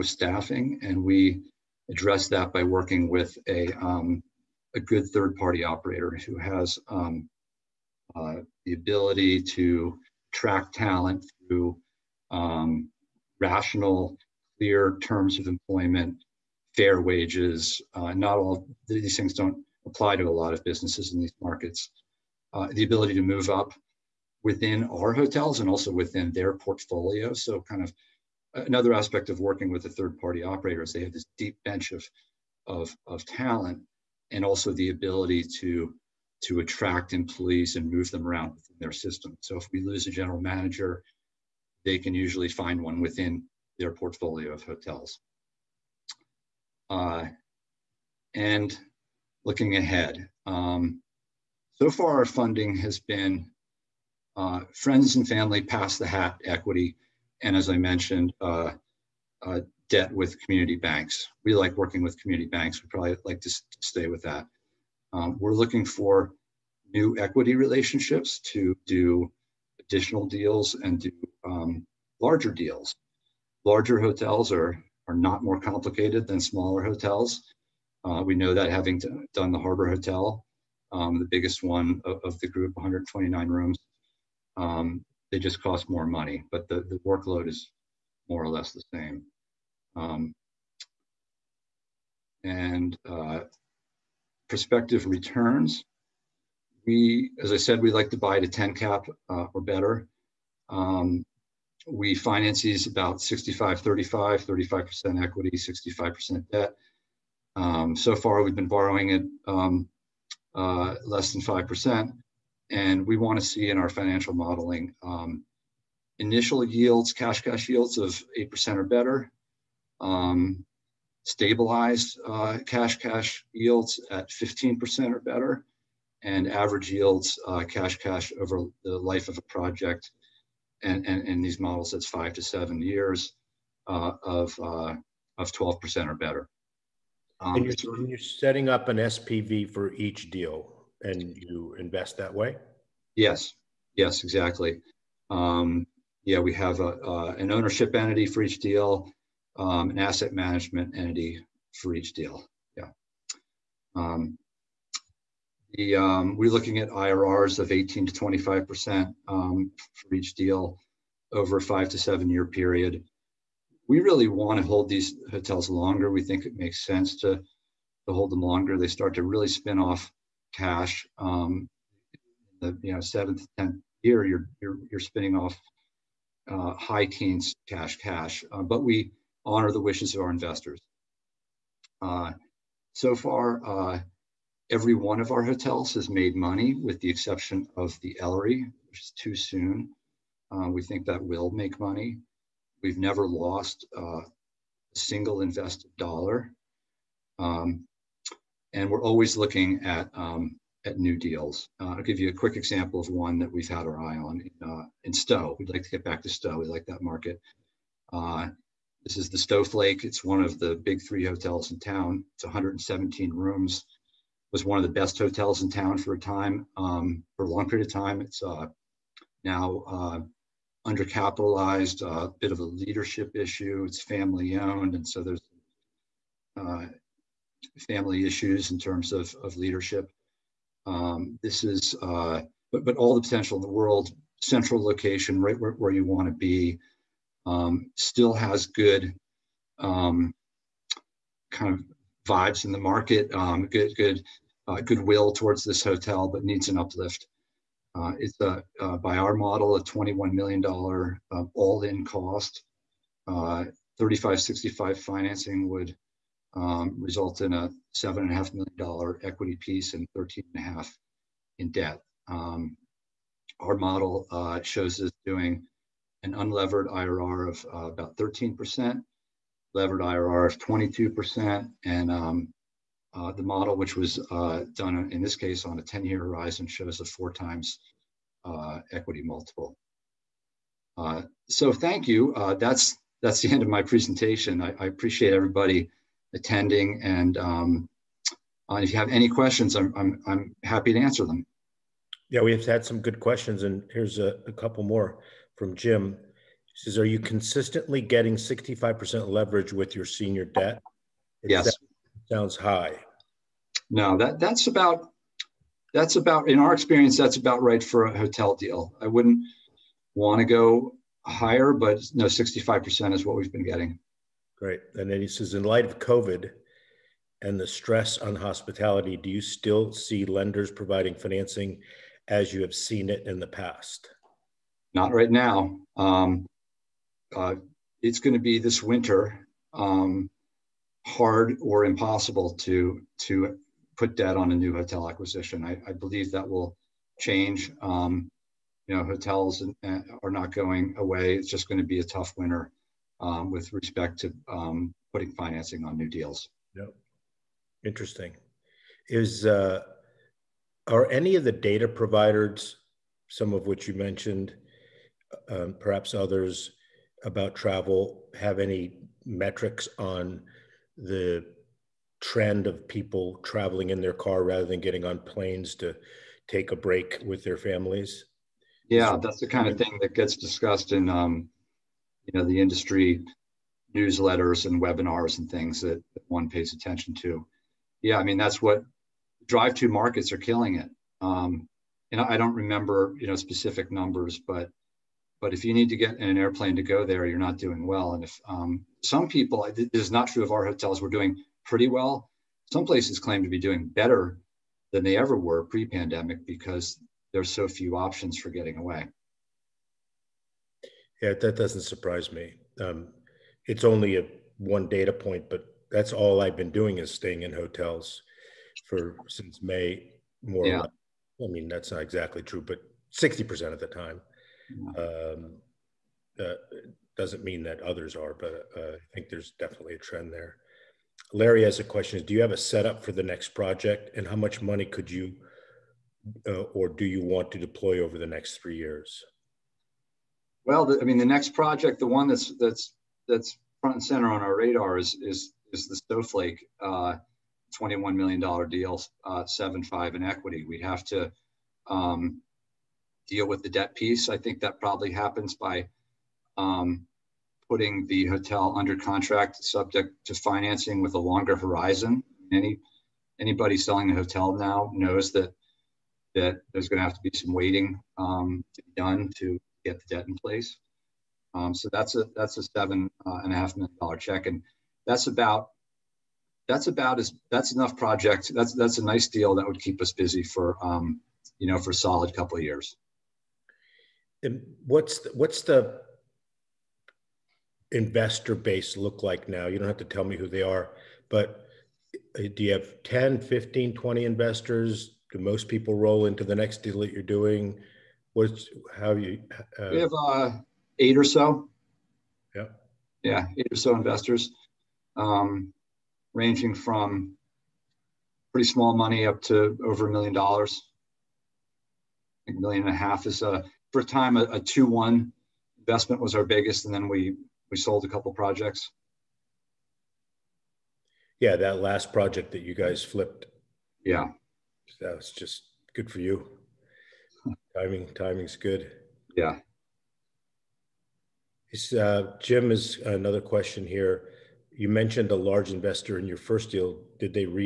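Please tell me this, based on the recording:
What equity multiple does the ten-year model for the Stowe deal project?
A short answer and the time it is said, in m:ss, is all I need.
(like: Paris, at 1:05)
4 times, at 4:37.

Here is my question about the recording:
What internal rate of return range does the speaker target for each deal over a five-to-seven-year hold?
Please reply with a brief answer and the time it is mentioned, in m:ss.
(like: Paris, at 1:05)
18 to 25%, at 2:37.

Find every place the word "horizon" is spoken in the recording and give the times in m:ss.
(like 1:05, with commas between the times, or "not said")
4:36, 7:31.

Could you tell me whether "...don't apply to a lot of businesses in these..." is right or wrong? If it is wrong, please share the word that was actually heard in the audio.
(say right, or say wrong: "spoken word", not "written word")
right.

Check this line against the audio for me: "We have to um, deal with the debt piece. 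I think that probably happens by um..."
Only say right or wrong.
right.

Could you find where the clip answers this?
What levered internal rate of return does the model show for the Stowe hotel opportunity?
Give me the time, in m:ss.
4:30.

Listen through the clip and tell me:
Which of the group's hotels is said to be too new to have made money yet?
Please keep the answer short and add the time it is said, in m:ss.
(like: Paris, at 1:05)
The Ellery, at 3:08.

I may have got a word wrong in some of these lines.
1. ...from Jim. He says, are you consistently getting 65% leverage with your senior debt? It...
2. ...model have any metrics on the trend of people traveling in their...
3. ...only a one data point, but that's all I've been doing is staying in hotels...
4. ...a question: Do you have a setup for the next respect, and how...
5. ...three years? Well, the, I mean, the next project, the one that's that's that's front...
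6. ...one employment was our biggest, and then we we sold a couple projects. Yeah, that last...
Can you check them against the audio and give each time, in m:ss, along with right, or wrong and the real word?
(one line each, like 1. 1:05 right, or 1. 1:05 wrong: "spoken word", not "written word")
1. 4:55 right
2. 5:57 wrong: "travel", not "model"
3. 6:43 right
4. 7:01 wrong: "project", not "respect"
5. 7:08 right
6. 8:24 wrong: "investment", not "employment".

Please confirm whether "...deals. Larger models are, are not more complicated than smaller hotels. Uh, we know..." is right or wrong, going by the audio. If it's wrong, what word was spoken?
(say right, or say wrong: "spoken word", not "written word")
wrong: "hotels", not "models".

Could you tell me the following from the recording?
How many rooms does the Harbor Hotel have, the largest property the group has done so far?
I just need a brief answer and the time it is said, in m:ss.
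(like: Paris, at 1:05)
129, at 1:22.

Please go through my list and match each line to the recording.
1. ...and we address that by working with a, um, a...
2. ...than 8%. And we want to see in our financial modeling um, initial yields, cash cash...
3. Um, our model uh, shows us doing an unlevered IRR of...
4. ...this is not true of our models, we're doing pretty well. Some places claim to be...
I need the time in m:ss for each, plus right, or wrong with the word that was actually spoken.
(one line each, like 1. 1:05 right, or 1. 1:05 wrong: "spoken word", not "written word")
1. 0:00 right
2. 1:51 wrong: "5", not "8"
3. 4:22 right
4. 6:29 wrong: "hotels", not "models".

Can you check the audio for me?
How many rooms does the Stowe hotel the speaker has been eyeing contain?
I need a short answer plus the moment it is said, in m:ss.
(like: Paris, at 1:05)
117, at 3:32.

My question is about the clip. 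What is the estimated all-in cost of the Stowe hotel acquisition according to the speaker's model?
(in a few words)
$21 million.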